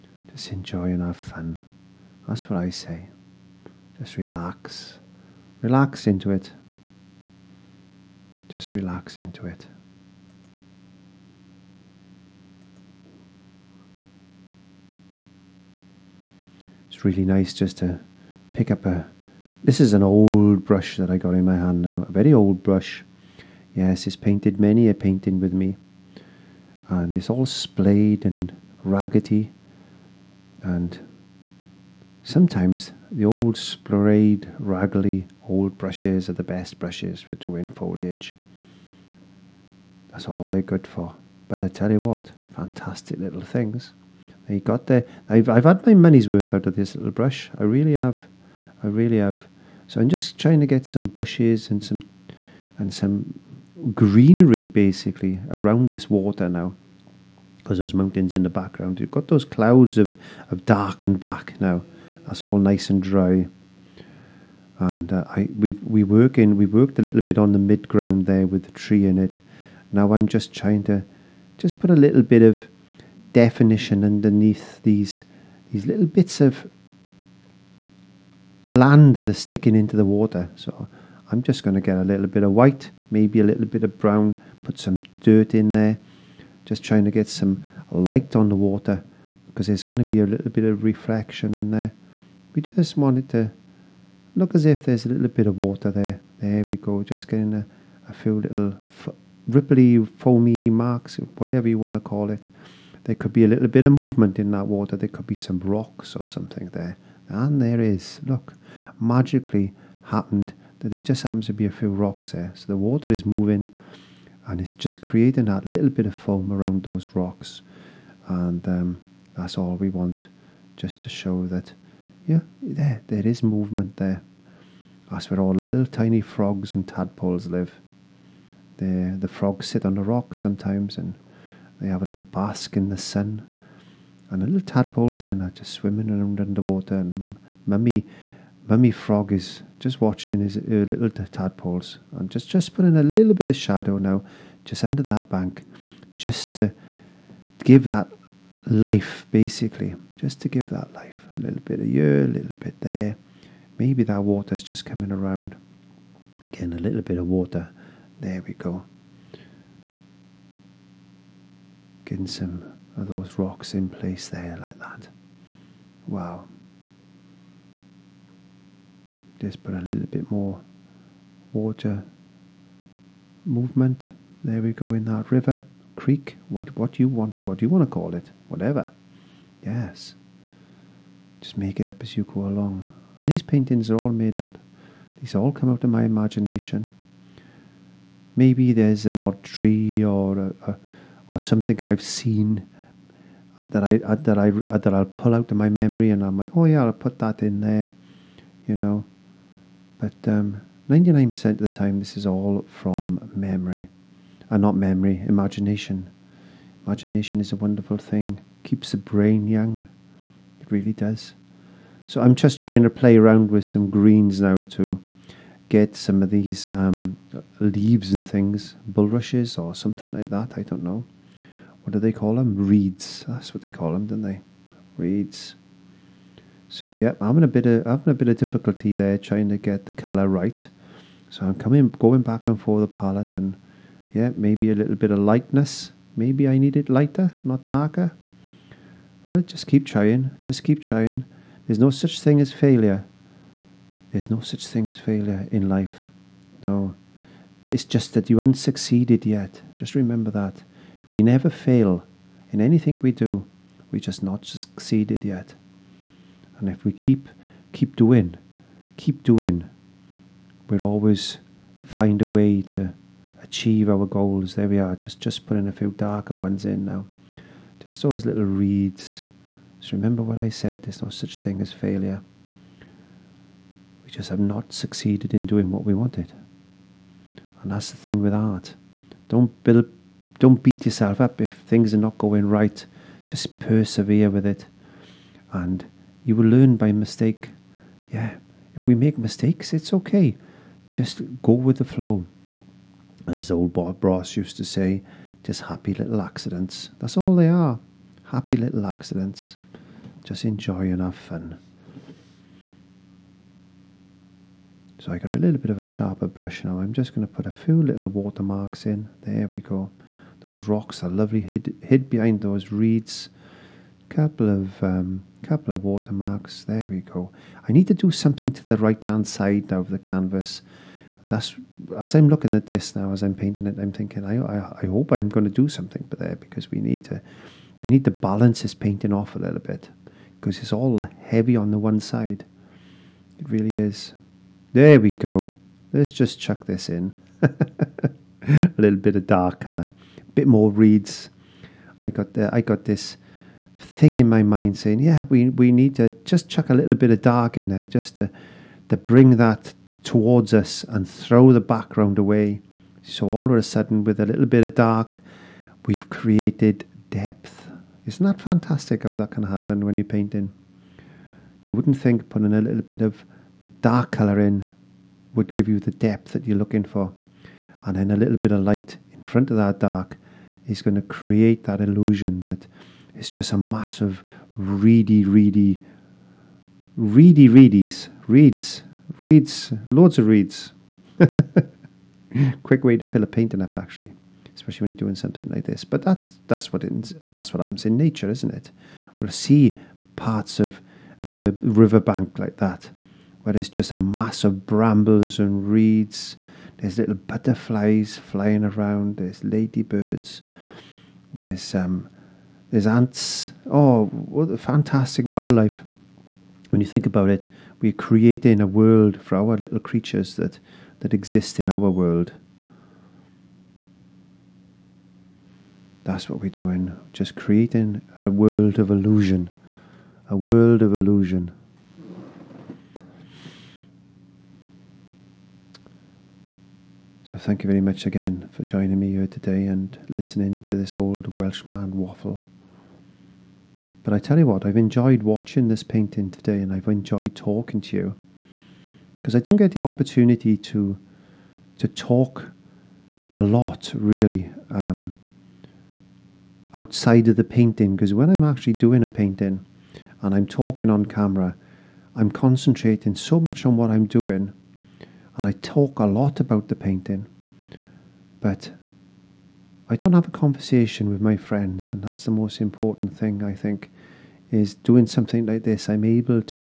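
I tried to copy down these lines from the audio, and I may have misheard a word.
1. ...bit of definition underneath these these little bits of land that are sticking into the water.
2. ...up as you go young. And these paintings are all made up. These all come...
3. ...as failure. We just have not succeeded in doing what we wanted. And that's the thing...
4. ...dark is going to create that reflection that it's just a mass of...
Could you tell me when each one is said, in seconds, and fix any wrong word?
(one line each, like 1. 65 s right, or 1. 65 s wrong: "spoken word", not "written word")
1. 72 s right
2. 181 s wrong: "along", not "young"
3. 271 s right
4. 369 s wrong: "illusion", not "reflection".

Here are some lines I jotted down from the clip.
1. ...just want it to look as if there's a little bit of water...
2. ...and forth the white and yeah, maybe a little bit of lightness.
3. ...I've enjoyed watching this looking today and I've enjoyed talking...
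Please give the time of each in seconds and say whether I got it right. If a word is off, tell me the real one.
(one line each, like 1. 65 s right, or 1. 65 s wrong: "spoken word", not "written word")
1. 92 s right
2. 232 s wrong: "palette", not "white"
3. 434 s wrong: "painting", not "looking".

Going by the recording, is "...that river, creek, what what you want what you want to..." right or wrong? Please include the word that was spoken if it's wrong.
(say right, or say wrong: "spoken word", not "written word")
right.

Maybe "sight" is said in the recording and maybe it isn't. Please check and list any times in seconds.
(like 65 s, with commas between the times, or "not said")
not said.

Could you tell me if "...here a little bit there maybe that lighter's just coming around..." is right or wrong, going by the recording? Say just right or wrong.
wrong.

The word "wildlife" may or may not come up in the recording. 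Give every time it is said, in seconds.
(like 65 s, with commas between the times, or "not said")
405 s.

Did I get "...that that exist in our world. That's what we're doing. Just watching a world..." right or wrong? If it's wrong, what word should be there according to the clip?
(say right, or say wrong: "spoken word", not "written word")
wrong: "creating", not "watching".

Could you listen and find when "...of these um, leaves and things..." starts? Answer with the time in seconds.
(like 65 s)
216 s.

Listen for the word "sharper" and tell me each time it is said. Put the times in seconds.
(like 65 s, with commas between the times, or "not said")
305 s.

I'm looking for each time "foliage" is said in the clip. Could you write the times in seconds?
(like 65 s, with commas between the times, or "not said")
37 s.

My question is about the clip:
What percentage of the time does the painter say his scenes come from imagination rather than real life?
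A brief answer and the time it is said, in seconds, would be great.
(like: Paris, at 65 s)
99%, at 200 s.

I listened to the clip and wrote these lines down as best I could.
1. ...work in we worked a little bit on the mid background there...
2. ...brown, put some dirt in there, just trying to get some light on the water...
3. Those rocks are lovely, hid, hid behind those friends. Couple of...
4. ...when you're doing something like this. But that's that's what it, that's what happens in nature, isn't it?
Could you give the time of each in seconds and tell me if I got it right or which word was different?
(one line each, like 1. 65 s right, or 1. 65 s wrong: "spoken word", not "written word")
1. 66 s wrong: "ground", not "background"
2. 83 s right
3. 310 s wrong: "reeds", not "friends"
4. 384 s right.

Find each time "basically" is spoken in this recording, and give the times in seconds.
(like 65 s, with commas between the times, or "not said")
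54 s, 149 s.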